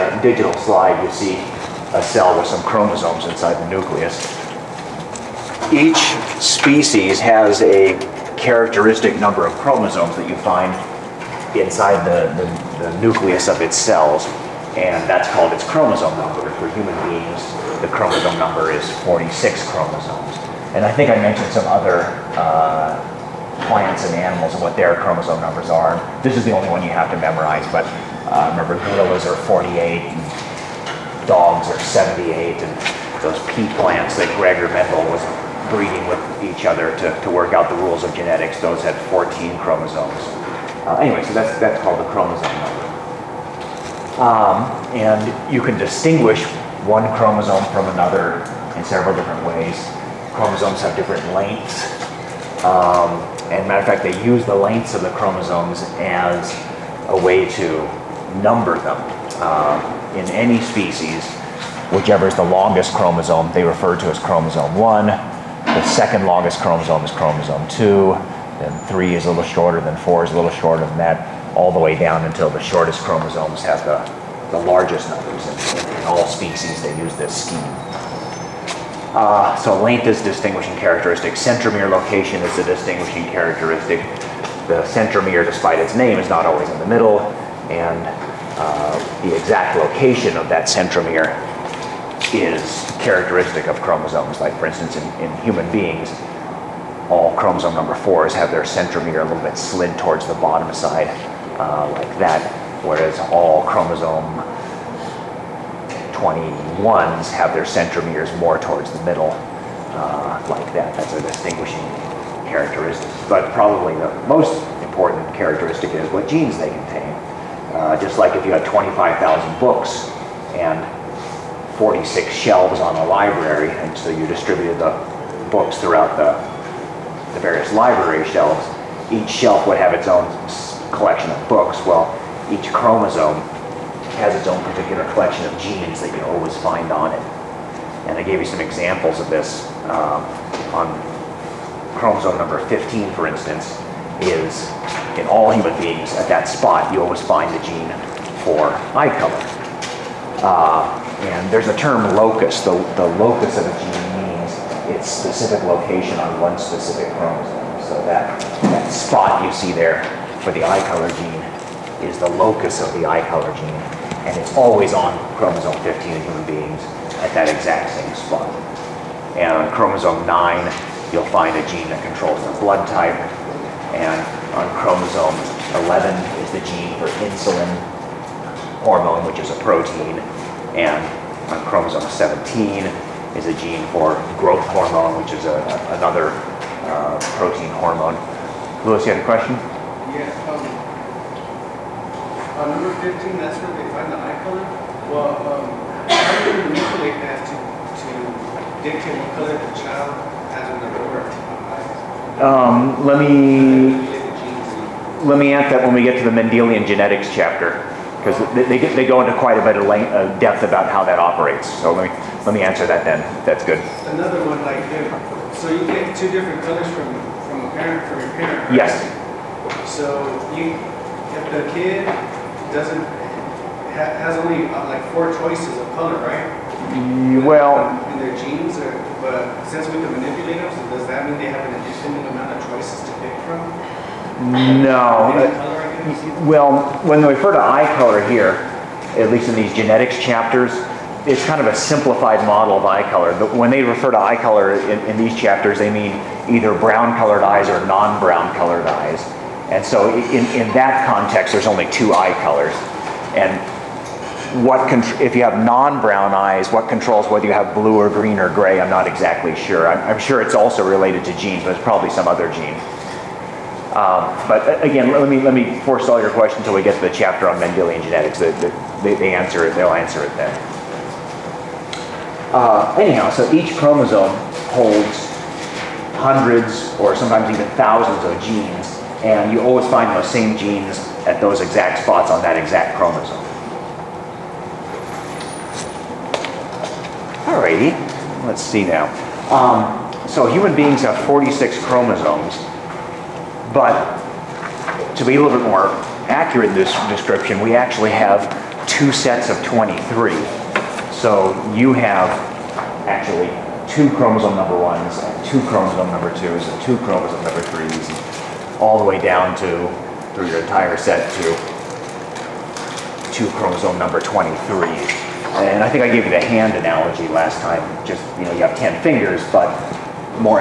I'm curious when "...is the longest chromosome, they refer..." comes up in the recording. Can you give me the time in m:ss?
1:02.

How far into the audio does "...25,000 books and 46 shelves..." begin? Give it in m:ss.
1:58.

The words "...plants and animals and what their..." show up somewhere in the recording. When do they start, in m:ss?
0:23.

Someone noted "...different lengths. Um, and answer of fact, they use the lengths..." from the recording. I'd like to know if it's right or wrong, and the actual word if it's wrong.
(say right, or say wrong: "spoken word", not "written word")
wrong: "matter", not "answer".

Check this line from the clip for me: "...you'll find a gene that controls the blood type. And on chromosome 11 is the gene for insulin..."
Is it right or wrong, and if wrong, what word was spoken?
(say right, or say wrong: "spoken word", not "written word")
right.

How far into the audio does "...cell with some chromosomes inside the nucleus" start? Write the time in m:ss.
0:02.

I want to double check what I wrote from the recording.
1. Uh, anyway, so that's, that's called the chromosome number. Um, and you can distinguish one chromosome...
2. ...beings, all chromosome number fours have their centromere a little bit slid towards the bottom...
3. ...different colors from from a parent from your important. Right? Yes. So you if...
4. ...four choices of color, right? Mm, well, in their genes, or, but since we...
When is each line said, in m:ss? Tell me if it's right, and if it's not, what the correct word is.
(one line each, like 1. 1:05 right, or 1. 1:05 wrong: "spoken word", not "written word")
1. 0:40 right
2. 1:35 right
3. 3:36 wrong: "parent", not "important"
4. 3:45 right.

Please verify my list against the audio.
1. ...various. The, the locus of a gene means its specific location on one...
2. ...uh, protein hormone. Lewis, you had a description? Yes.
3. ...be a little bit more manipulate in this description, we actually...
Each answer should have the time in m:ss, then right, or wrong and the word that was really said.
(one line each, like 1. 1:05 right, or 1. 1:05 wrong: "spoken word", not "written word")
1. 2:32 wrong: "locus", not "various"
2. 3:06 wrong: "question", not "description"
3. 4:55 wrong: "accurate", not "manipulate".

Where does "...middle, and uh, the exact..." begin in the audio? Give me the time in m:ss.
1:26.